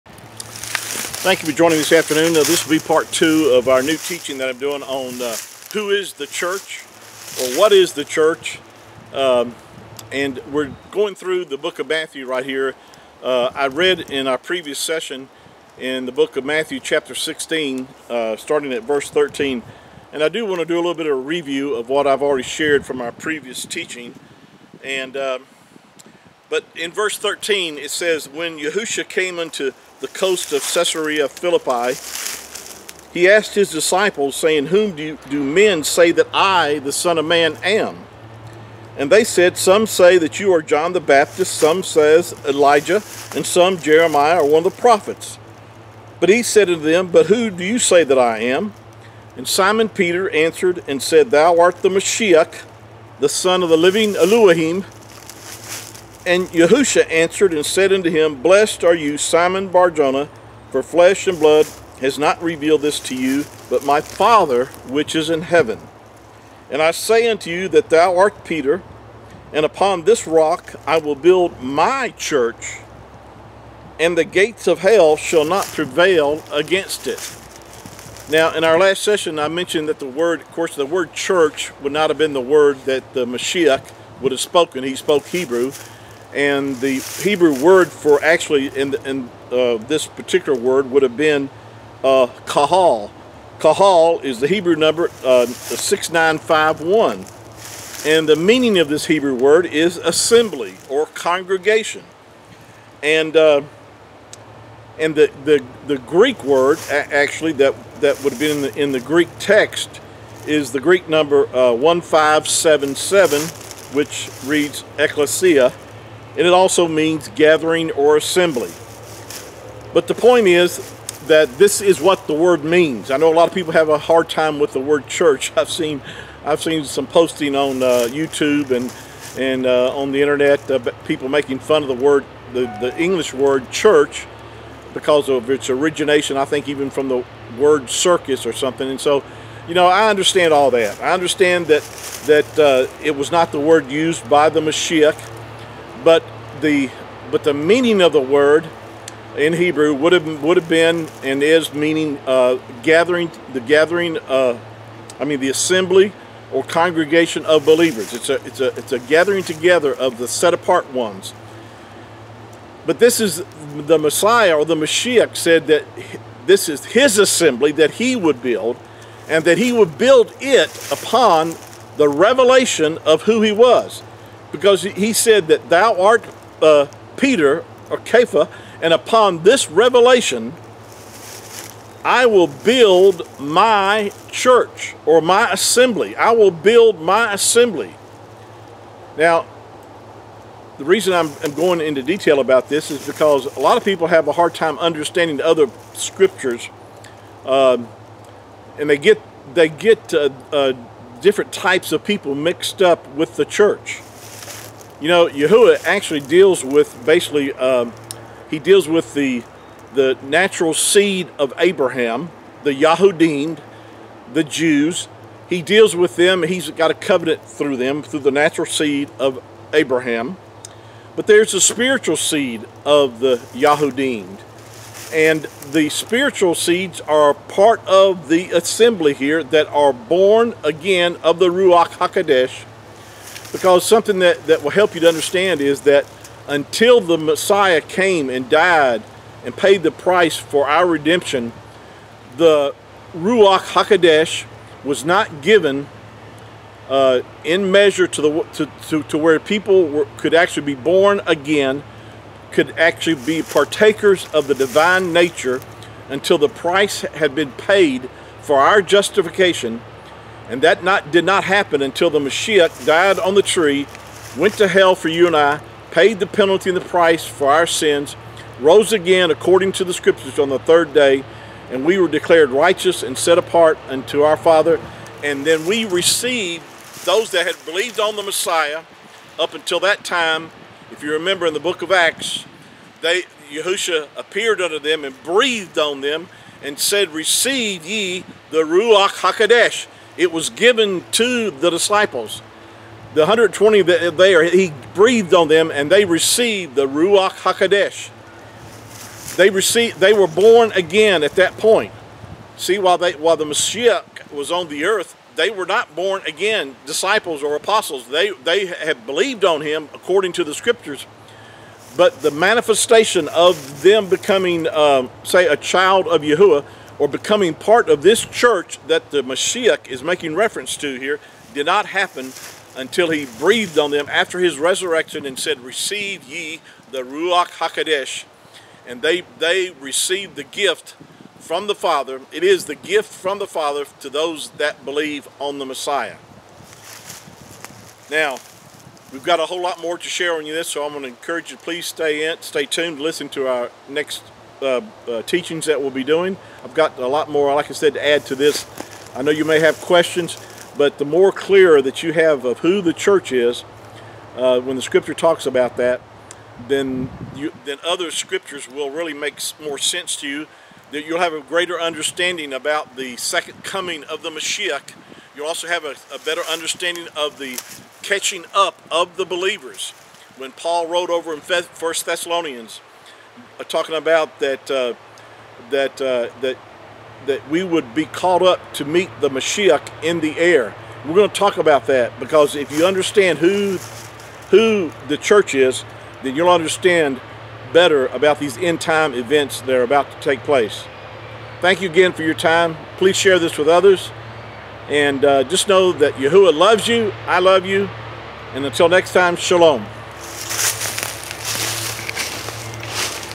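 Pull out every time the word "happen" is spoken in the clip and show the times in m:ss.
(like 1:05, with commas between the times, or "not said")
4:21, 5:21.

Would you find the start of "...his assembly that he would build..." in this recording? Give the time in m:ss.
2:46.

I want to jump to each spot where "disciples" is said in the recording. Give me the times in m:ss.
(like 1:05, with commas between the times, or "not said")
0:33, 4:51, 5:06.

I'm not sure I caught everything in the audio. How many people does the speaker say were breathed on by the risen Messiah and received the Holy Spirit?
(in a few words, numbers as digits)
120.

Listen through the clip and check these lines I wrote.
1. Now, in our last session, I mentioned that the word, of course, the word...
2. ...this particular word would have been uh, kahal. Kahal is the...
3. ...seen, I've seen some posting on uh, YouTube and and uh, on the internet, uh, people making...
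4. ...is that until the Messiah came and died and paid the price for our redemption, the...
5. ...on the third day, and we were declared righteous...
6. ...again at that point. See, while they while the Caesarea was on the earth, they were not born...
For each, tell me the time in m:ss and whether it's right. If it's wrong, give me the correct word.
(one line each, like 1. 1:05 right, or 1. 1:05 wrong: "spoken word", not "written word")
1. 1:18 right
2. 1:29 right
3. 2:05 right
4. 3:55 right
5. 4:30 right
6. 5:00 wrong: "Messiah", not "Caesarea".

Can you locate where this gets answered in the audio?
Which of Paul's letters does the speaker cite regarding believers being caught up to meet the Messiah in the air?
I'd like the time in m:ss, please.
6:11.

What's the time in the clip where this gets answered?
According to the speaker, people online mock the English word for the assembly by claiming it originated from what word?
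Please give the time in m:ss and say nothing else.
2:17.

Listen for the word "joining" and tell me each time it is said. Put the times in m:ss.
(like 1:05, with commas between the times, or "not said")
0:01.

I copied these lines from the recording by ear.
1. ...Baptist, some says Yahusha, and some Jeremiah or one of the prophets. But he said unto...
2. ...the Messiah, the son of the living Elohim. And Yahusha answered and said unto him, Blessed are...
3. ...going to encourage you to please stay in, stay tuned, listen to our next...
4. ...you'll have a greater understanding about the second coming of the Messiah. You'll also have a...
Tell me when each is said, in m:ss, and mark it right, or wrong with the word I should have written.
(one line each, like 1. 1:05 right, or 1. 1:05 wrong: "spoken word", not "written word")
1. 0:40 wrong: "Elijah", not "Yahusha"
2. 0:51 right
3. 5:40 right
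4. 6:01 right.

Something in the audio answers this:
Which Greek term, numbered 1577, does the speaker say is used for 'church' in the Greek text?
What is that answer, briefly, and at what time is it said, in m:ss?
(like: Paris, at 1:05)
ecclesia, at 1:54.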